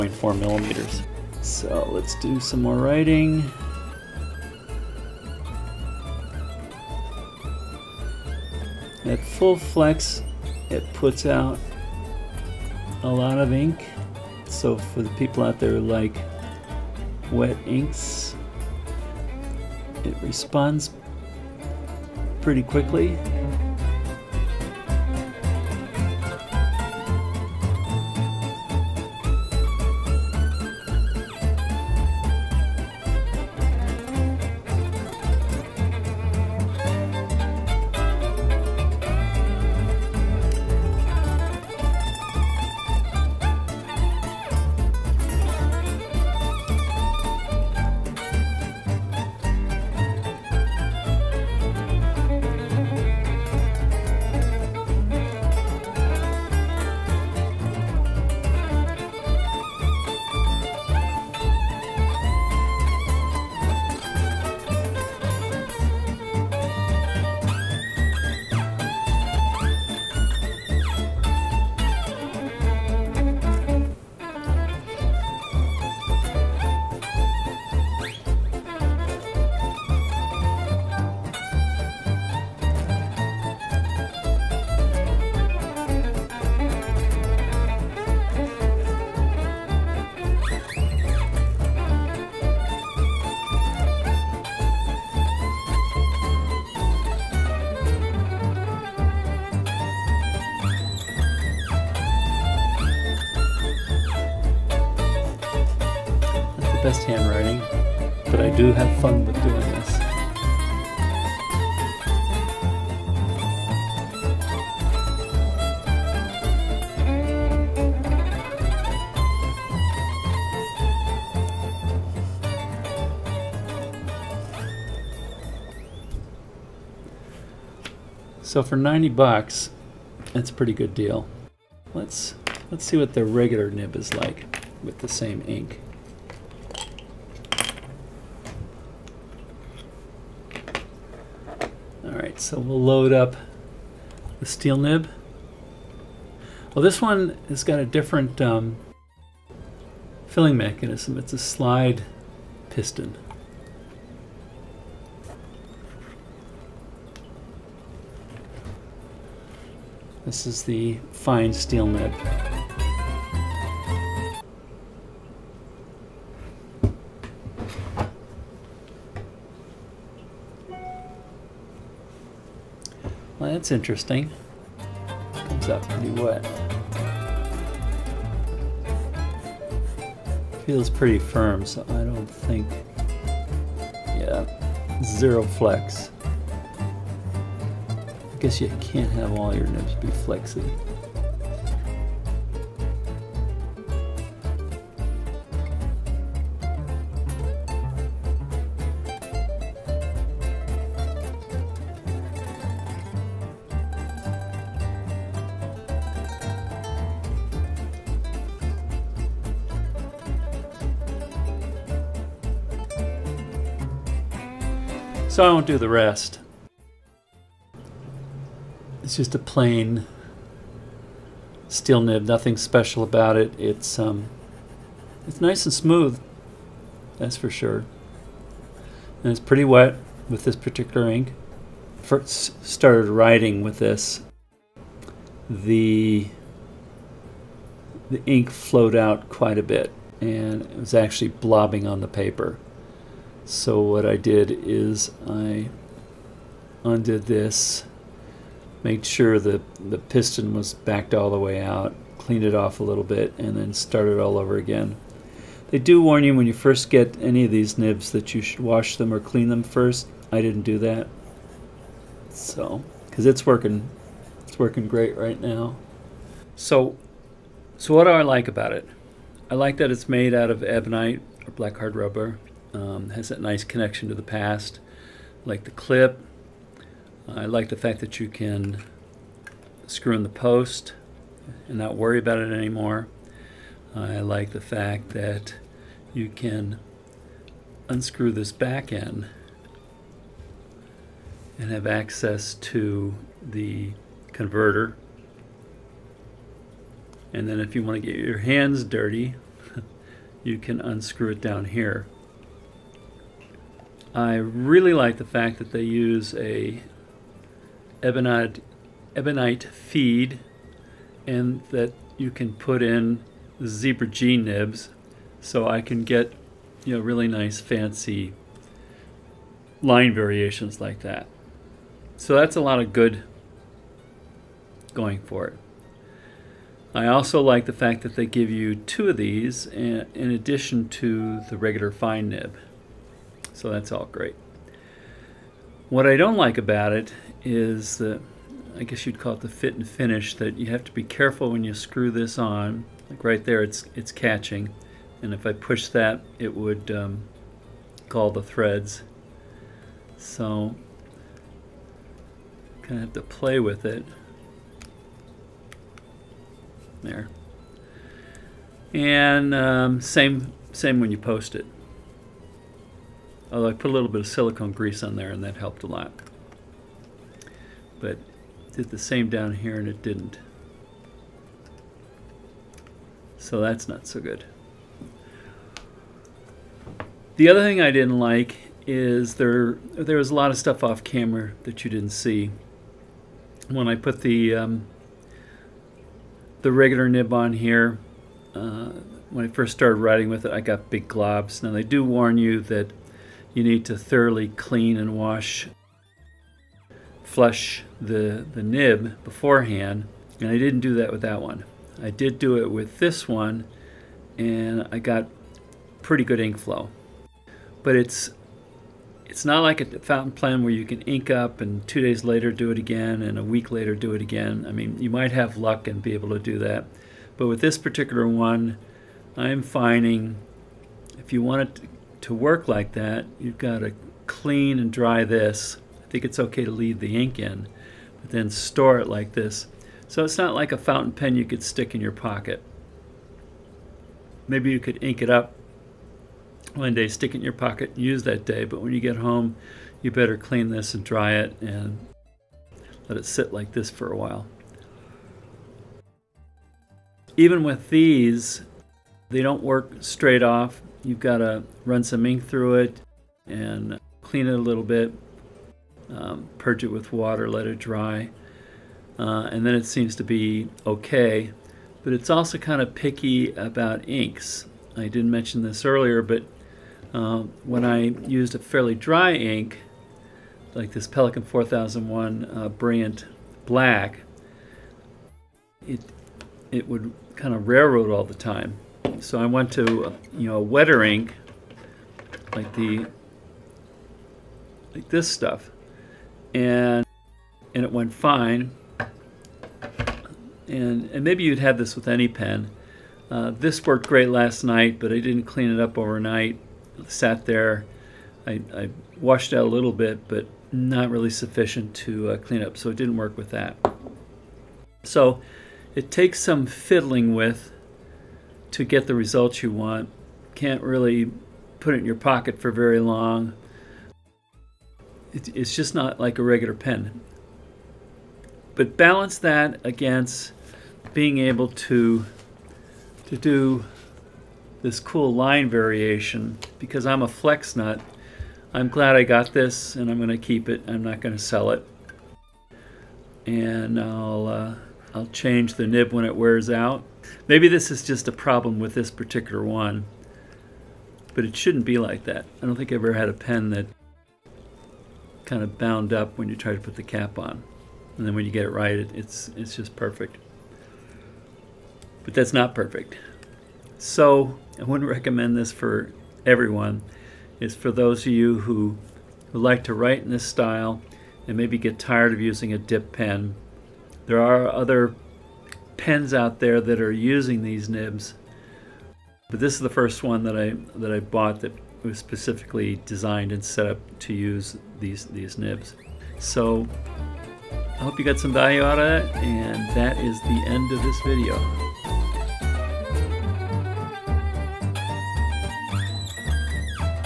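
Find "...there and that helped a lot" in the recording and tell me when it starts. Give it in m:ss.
6:05.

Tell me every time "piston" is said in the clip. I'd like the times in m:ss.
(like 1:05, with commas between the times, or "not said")
2:32, 4:09.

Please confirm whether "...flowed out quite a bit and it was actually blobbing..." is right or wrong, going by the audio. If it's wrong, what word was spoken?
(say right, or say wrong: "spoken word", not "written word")
right.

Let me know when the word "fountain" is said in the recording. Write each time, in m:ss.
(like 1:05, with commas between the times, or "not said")
6:50, 7:10.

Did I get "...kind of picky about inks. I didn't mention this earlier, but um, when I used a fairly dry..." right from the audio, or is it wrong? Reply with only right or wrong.
right.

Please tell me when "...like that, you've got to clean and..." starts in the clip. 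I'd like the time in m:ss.
7:02.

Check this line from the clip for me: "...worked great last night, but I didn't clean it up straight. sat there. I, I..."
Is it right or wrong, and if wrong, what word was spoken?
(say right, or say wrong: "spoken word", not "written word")
wrong: "overnight", not "straight".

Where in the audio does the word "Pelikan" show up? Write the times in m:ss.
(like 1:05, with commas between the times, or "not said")
7:51.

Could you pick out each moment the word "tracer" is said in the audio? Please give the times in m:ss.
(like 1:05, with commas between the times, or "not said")
not said.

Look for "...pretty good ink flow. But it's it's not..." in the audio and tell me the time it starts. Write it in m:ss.
6:46.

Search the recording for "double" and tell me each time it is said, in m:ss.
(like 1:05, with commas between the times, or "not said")
not said.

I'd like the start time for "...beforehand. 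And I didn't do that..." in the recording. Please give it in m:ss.
6:39.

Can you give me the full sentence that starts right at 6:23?
When I put the um, the regular nib on here, uh, when I first started writing with it, I got big globs.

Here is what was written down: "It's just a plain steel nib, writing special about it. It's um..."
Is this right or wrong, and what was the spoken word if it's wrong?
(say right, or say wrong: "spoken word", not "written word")
wrong: "nothing", not "writing".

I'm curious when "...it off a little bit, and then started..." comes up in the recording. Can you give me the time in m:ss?
4:12.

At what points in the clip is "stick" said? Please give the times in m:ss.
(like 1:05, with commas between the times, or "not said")
7:11, 7:17.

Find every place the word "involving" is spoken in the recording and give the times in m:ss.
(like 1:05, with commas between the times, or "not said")
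not said.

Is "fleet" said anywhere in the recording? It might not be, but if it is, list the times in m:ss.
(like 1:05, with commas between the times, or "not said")
not said.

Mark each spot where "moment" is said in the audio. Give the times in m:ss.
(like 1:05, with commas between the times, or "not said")
not said.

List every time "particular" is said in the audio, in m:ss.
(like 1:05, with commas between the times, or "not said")
3:50, 6:57, 8:59.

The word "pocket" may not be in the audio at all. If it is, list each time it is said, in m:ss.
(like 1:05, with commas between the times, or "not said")
7:12, 7:17, 8:32.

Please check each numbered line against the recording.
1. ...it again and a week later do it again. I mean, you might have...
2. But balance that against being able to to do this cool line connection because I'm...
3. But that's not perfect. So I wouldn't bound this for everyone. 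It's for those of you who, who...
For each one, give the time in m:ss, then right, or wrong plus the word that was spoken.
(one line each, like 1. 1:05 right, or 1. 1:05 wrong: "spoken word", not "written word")
1. 6:52 right
2. 8:38 wrong: "variation", not "connection"
3. 9:12 wrong: "recommend", not "bound".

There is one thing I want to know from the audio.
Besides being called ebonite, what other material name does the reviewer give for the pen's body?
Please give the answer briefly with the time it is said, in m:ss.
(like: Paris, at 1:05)
black hard rubber, at 4:31.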